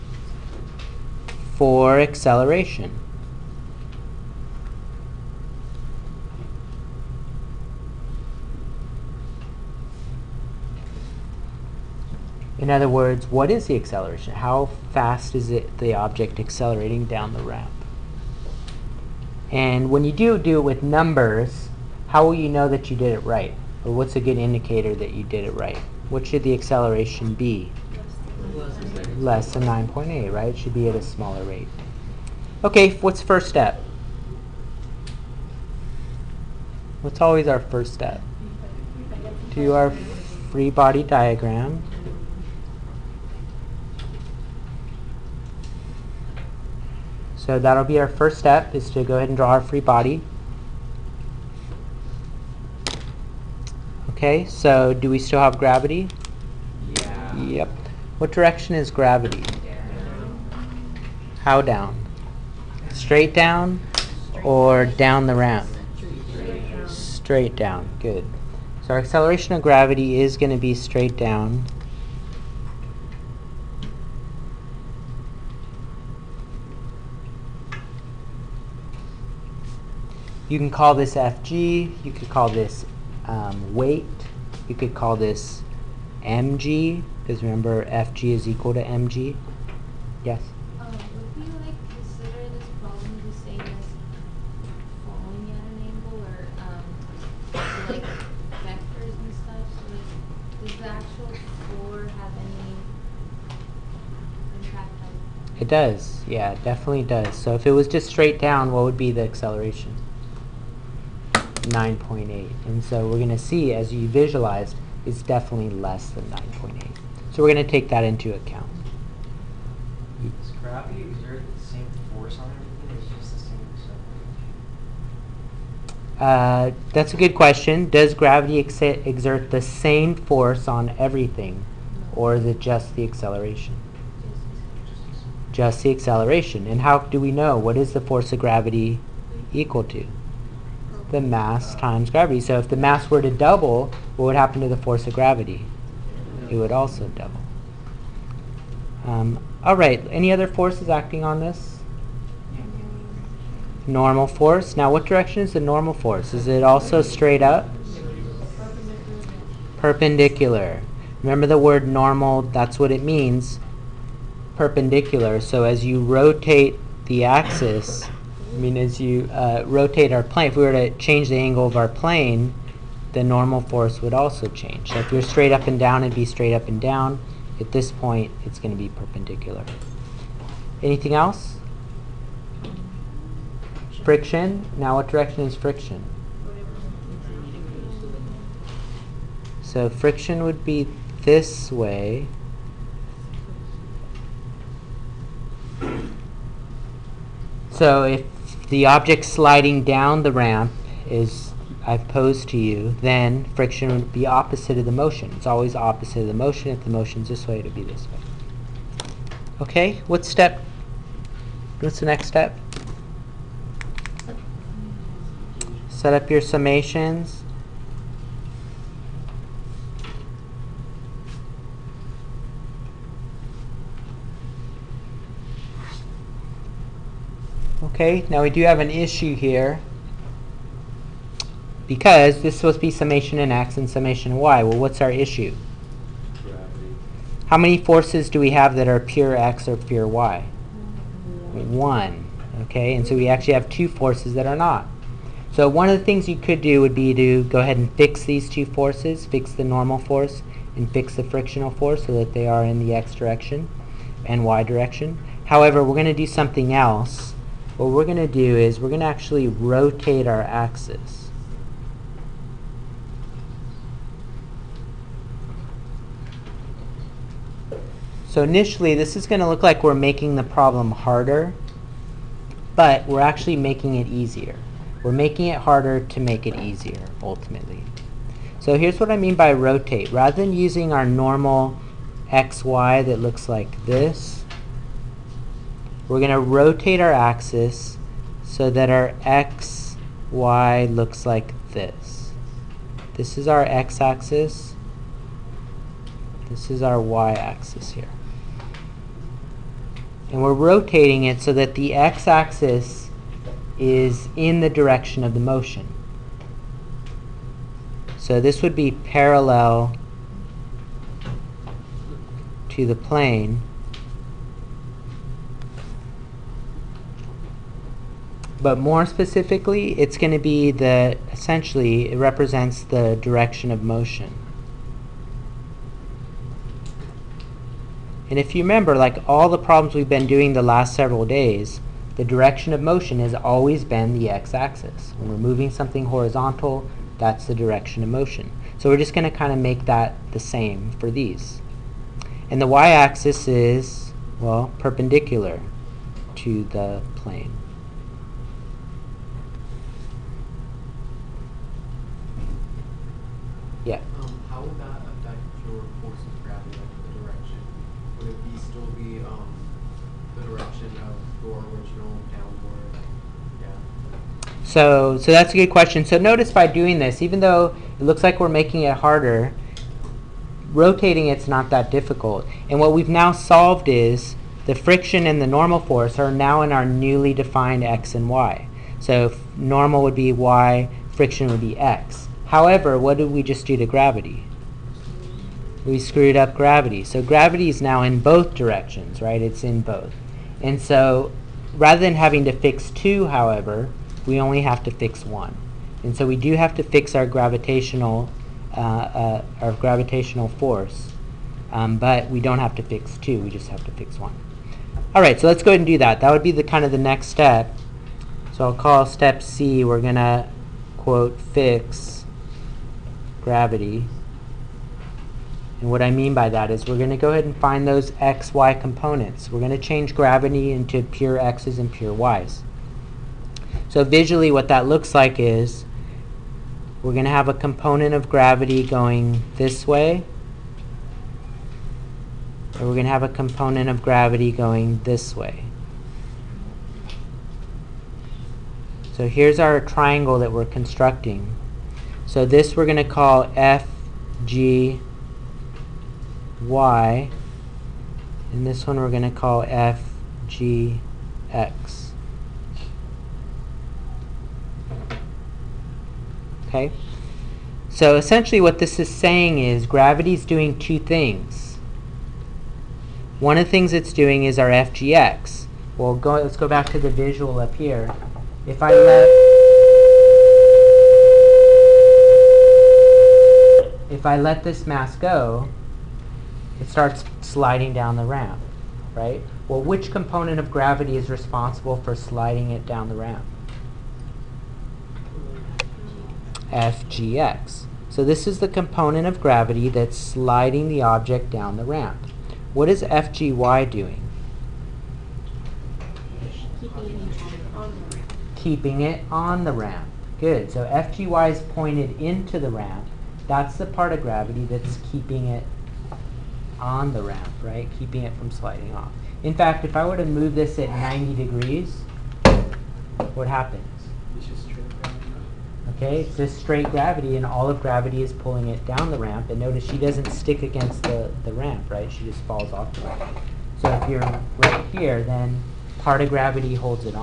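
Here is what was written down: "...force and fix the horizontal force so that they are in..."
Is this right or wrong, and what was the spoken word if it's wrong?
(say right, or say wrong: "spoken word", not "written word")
wrong: "frictional", not "horizontal".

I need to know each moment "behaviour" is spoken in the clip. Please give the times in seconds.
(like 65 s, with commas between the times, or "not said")
not said.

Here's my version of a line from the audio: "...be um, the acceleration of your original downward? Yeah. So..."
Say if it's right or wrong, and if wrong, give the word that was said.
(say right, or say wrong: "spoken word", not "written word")
wrong: "direction", not "acceleration".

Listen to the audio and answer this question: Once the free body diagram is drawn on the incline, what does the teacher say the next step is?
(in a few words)
Set up your summations.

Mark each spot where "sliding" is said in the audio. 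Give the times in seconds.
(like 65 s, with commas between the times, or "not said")
199 s, 477 s, 482 s, 490 s, 508 s.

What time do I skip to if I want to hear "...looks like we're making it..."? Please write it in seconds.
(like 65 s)
368 s.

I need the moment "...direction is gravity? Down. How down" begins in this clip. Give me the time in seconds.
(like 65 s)
58 s.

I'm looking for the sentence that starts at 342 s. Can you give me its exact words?
And the y-axis is, well, perpendicular to the plane.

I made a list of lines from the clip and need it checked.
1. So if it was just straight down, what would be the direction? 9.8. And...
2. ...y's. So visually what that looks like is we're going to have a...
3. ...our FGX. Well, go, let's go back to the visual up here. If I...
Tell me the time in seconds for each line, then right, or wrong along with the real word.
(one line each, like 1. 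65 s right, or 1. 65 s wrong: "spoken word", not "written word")
1. 107 s wrong: "acceleration", not "direction"
2. 422 s right
3. 464 s right.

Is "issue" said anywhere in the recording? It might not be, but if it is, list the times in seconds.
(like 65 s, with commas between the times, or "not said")
228 s, 235 s.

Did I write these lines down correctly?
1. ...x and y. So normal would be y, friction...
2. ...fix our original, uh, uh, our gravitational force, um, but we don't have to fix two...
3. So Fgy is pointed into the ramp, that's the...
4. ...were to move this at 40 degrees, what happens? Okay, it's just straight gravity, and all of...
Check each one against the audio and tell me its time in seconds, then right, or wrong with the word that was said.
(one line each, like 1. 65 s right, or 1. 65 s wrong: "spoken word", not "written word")
1. 377 s right
2. 396 s wrong: "gravitational", not "original"
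3. 500 s right
4. 510 s wrong: "90", not "40".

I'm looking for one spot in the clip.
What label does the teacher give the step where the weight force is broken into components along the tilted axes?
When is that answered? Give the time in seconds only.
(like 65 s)
411 s.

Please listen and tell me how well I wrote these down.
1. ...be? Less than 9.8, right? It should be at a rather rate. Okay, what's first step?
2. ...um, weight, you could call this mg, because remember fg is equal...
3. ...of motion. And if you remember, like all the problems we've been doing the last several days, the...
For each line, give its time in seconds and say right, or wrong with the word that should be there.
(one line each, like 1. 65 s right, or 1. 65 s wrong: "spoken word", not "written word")
1. 27 s wrong: "smaller", not "rather"
2. 83 s right
3. 323 s right.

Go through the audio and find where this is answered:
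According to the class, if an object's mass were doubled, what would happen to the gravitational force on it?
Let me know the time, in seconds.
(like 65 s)
146 s.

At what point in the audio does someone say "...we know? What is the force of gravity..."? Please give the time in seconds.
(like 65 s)
137 s.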